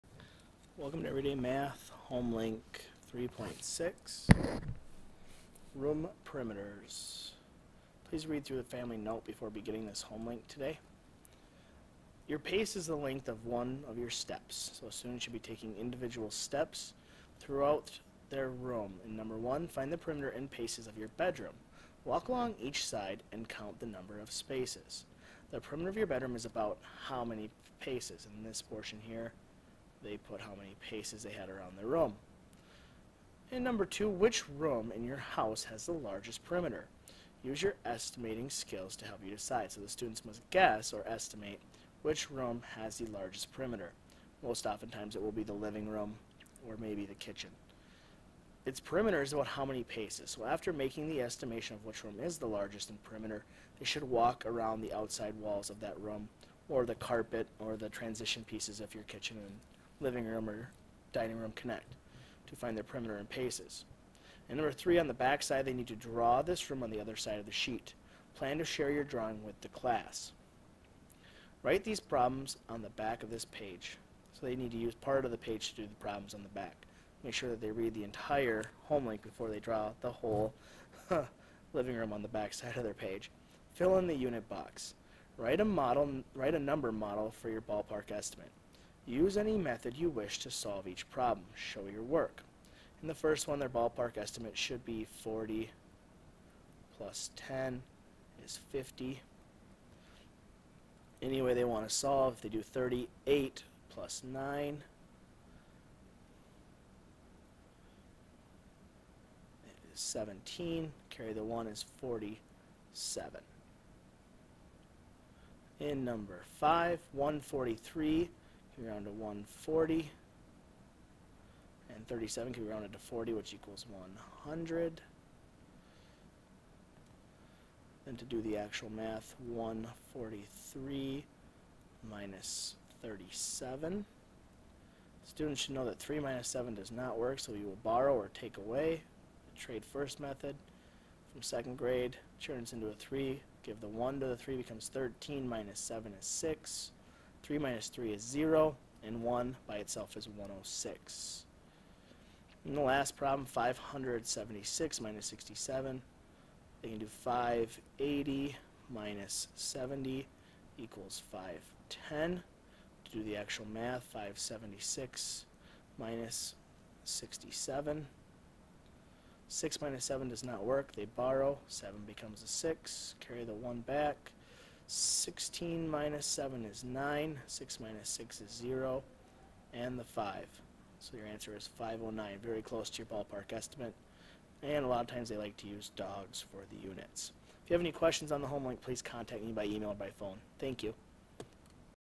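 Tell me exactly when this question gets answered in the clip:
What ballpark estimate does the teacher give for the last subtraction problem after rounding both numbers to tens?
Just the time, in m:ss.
2:41.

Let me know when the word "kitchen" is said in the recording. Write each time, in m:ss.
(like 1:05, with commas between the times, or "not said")
0:47, 0:59.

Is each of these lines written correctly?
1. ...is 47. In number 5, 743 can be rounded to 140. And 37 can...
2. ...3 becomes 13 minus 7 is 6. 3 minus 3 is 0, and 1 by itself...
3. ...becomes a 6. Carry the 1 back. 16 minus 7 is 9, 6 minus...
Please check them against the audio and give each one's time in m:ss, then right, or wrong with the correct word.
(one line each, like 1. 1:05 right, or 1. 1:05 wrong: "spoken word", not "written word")
1. 1:51 wrong: "143", not "743"
2. 2:24 right
3. 2:52 right.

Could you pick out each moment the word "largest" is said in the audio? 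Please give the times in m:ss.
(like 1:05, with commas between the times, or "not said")
0:35, 0:43, 0:52.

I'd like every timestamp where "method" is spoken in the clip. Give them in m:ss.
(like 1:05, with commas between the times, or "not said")
1:29, 2:20.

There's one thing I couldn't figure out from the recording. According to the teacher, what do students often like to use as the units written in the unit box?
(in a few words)
dogs.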